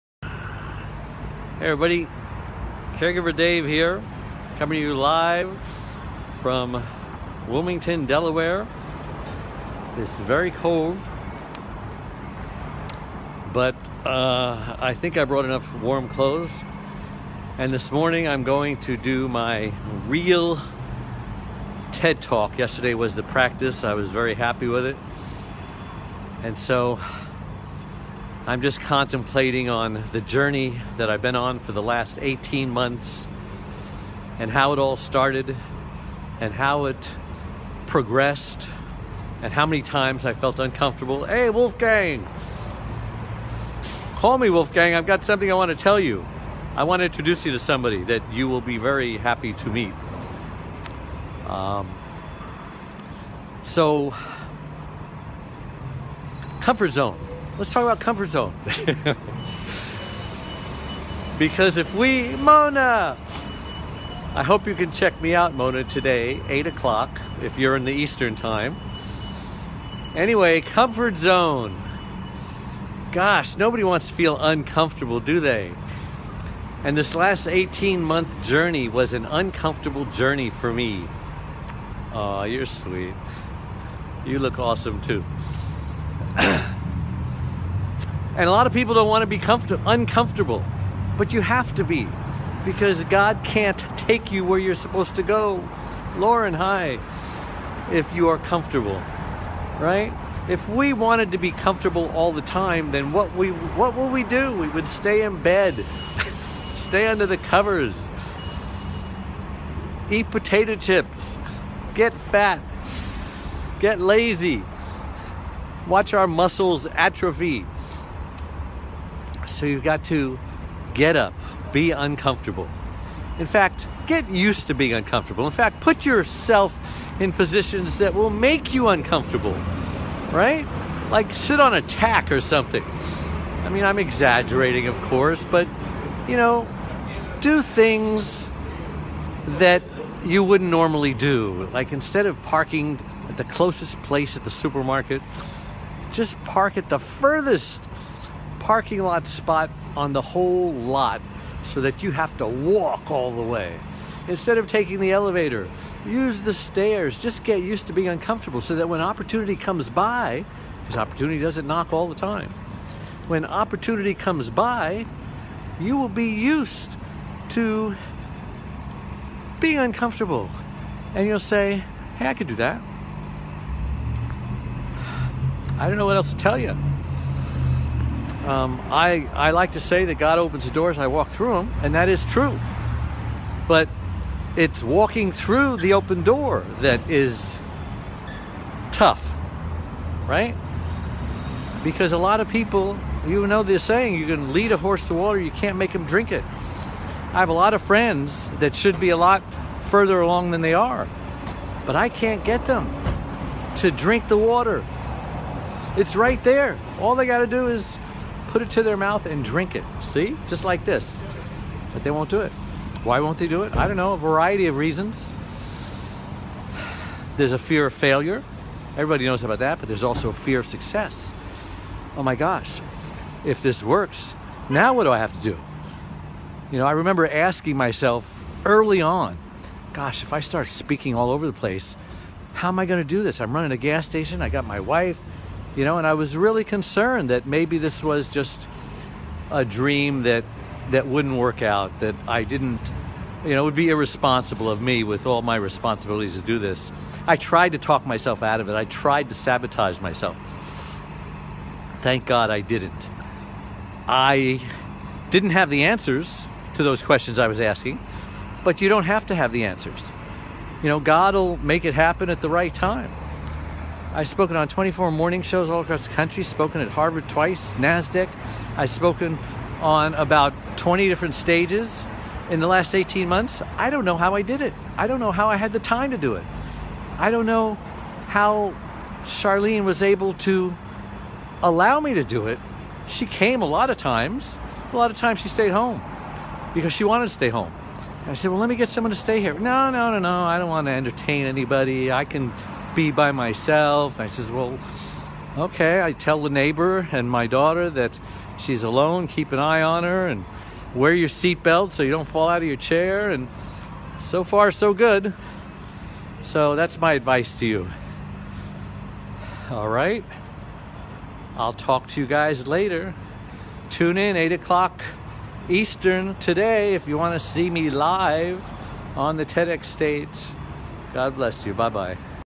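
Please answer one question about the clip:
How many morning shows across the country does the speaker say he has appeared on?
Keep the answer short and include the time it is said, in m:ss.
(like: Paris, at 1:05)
24, at 4:24.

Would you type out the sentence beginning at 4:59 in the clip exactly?
Keep an eye on her and wear your seatbelt so you don't fall out of your chair.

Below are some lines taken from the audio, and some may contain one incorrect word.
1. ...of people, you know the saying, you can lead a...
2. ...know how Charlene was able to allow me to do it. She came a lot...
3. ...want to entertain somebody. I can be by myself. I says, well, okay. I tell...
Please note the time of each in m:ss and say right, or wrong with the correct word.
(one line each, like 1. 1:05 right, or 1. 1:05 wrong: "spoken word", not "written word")
1. 3:12 right
2. 4:37 right
3. 4:50 wrong: "anybody", not "somebody".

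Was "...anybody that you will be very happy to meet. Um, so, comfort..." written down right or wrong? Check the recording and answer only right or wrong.
wrong.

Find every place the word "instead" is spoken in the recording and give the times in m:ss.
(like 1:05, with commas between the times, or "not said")
2:21, 2:34.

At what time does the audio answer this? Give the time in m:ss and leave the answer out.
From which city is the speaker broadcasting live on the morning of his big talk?
0:07.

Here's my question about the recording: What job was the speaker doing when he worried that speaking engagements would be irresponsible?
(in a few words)
running a gas station.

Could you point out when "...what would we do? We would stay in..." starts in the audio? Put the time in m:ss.
1:43.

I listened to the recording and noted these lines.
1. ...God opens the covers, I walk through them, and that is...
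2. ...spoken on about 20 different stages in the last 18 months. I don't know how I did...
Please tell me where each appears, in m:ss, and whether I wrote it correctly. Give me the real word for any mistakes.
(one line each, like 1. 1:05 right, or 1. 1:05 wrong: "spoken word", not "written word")
1. 3:00 wrong: "doors", not "covers"
2. 4:28 right.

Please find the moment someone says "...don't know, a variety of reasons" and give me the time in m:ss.
3:33.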